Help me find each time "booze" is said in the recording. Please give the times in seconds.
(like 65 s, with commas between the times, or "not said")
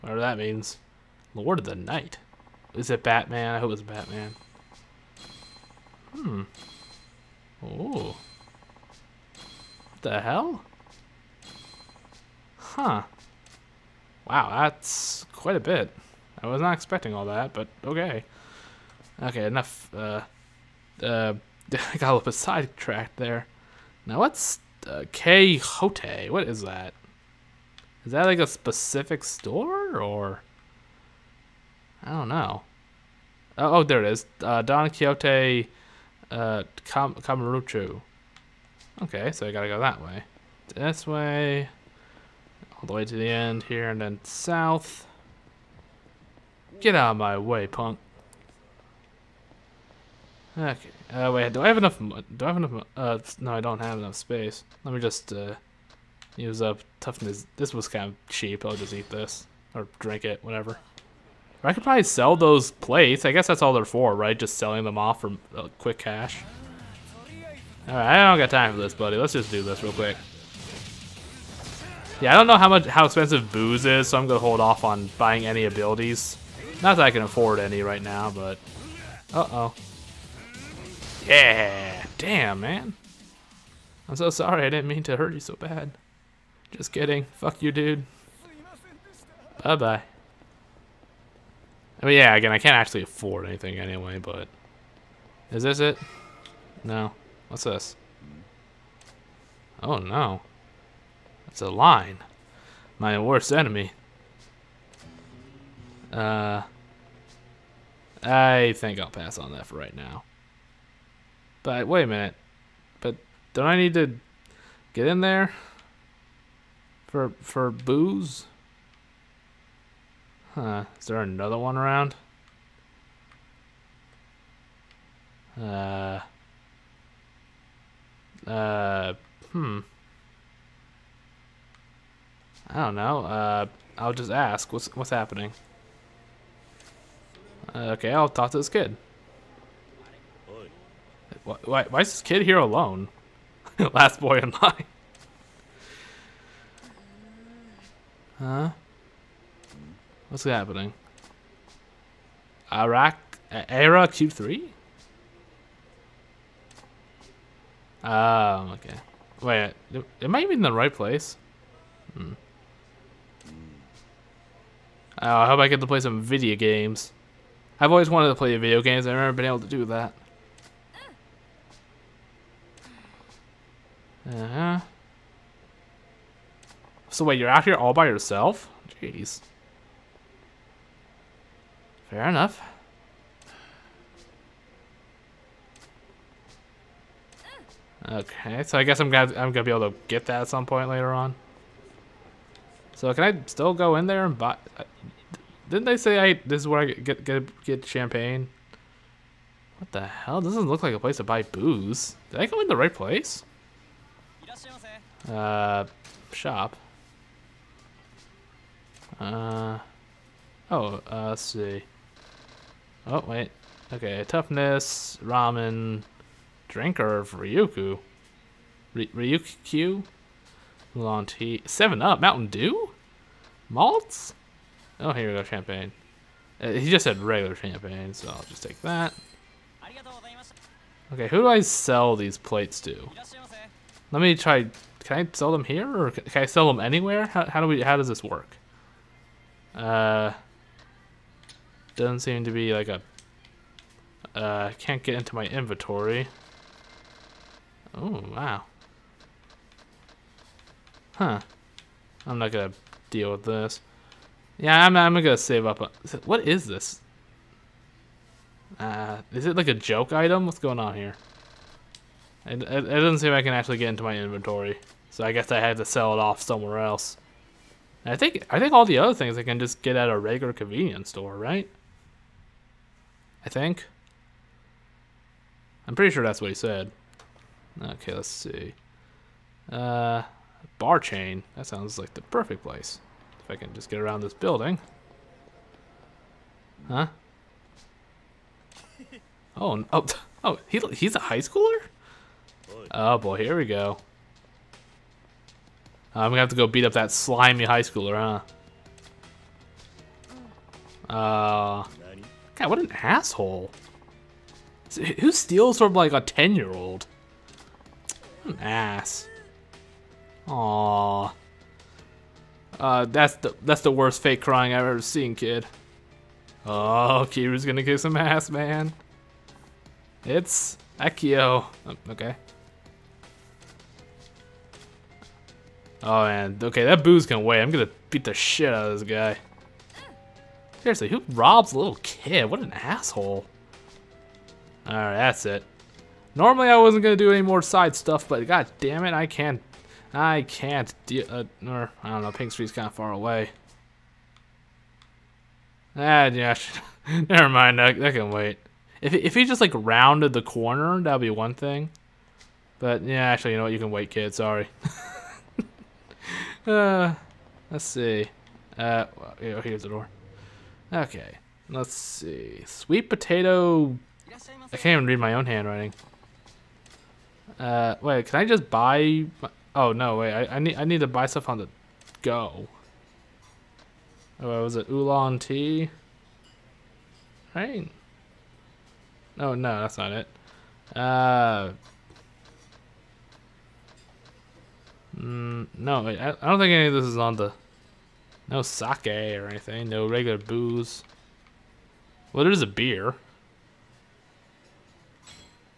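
73 s, 117 s, 201 s, 390 s.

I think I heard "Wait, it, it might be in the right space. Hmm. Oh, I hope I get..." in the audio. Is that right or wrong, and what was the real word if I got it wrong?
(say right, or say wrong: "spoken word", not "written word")
wrong: "place", not "space".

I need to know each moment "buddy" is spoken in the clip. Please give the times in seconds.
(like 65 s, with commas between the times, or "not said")
68 s.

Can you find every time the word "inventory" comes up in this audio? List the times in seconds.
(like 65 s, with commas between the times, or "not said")
245 s, 264 s.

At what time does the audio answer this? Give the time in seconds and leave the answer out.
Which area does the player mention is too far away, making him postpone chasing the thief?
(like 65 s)
342 s.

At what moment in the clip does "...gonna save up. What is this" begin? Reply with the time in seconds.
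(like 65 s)
255 s.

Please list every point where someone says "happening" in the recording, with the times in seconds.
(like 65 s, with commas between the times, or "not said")
135 s, 150 s.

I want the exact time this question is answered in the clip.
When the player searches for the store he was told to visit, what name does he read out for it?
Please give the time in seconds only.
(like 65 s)
34 s.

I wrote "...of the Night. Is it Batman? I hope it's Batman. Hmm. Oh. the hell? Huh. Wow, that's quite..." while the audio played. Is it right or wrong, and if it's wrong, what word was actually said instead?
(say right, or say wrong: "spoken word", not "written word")
right.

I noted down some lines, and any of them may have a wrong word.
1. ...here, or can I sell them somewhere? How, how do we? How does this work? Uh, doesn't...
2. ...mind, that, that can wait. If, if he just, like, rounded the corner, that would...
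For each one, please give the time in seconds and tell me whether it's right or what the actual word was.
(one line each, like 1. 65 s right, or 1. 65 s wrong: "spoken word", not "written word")
1. 235 s wrong: "anywhere", not "somewhere"
2. 347 s right.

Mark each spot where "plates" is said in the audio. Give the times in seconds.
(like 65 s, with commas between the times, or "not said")
62 s, 232 s.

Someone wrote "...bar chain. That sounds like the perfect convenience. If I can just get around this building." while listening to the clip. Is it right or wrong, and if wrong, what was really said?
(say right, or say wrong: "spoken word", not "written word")
wrong: "place", not "convenience".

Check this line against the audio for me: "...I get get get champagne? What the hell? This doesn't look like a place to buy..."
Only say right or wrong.
right.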